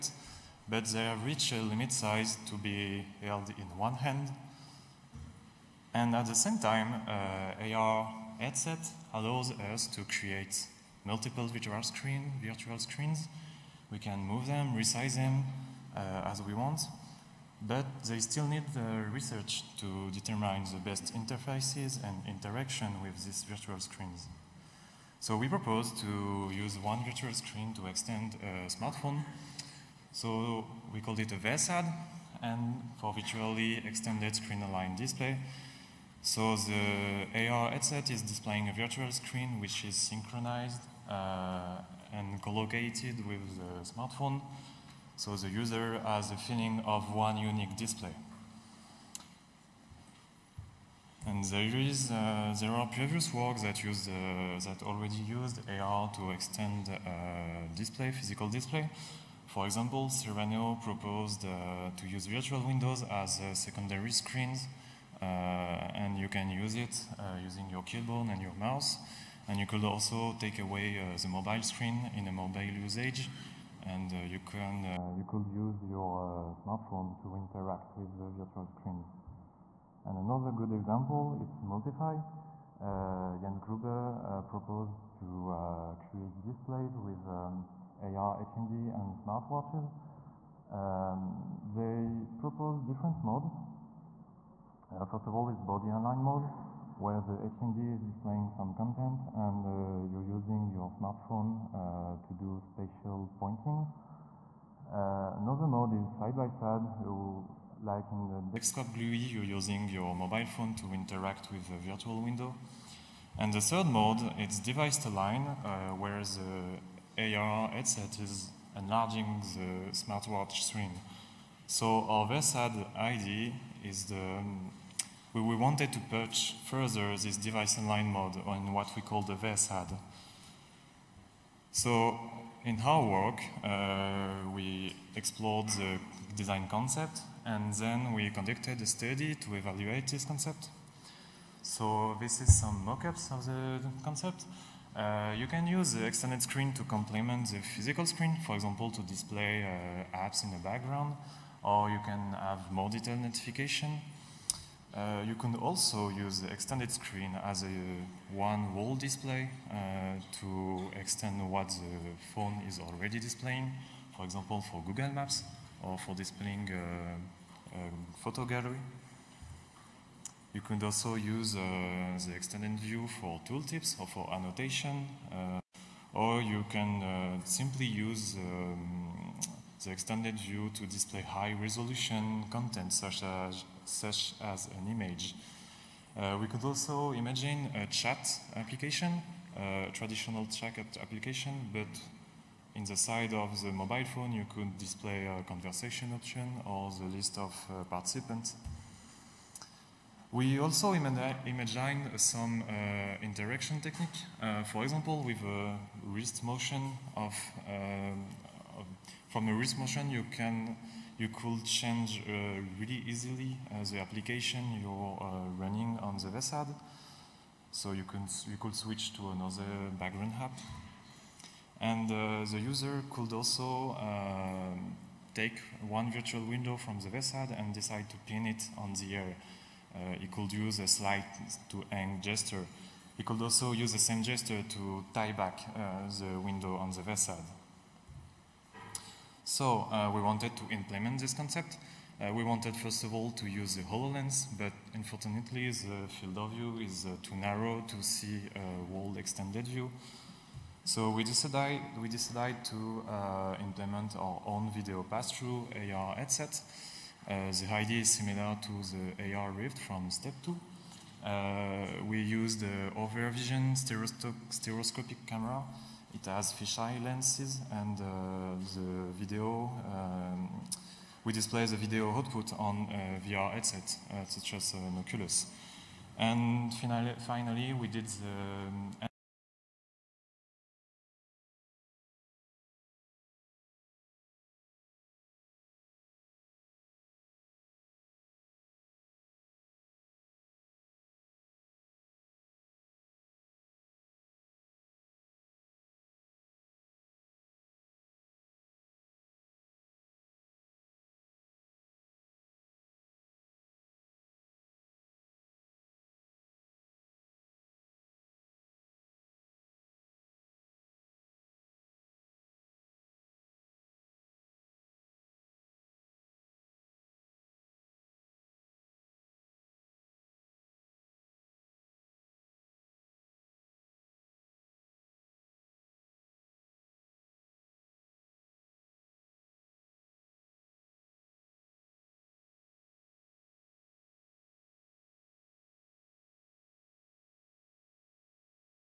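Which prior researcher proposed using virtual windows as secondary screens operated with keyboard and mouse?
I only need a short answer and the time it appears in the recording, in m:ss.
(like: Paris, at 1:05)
Serrano, at 1:00.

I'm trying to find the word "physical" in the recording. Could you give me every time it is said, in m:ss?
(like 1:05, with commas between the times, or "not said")
0:58, 2:27.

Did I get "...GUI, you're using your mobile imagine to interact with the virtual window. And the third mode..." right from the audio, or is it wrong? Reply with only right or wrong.
wrong.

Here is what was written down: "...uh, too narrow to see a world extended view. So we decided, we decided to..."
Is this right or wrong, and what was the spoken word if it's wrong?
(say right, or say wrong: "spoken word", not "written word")
right.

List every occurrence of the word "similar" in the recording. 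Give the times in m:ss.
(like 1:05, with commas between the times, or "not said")
4:18.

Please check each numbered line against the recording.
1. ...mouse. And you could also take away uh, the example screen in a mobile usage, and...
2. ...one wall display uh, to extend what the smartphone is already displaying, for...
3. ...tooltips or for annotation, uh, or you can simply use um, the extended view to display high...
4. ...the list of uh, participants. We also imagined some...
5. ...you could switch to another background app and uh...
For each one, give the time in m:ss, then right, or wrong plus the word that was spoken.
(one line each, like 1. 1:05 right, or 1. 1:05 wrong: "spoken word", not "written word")
1. 1:08 wrong: "mobile", not "example"
2. 2:38 wrong: "phone", not "smartphone"
3. 2:53 right
4. 3:16 right
5. 3:38 right.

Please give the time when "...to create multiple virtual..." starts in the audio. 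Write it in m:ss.
0:09.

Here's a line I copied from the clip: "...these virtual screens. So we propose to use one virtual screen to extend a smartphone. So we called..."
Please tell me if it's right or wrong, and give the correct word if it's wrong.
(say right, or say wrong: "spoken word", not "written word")
right.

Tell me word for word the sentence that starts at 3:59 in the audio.
So uh, we wanted to implement this concept.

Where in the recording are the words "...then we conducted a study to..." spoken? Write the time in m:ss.
2:17.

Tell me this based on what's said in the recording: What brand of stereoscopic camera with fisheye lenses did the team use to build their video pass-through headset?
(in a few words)
Ovrvision.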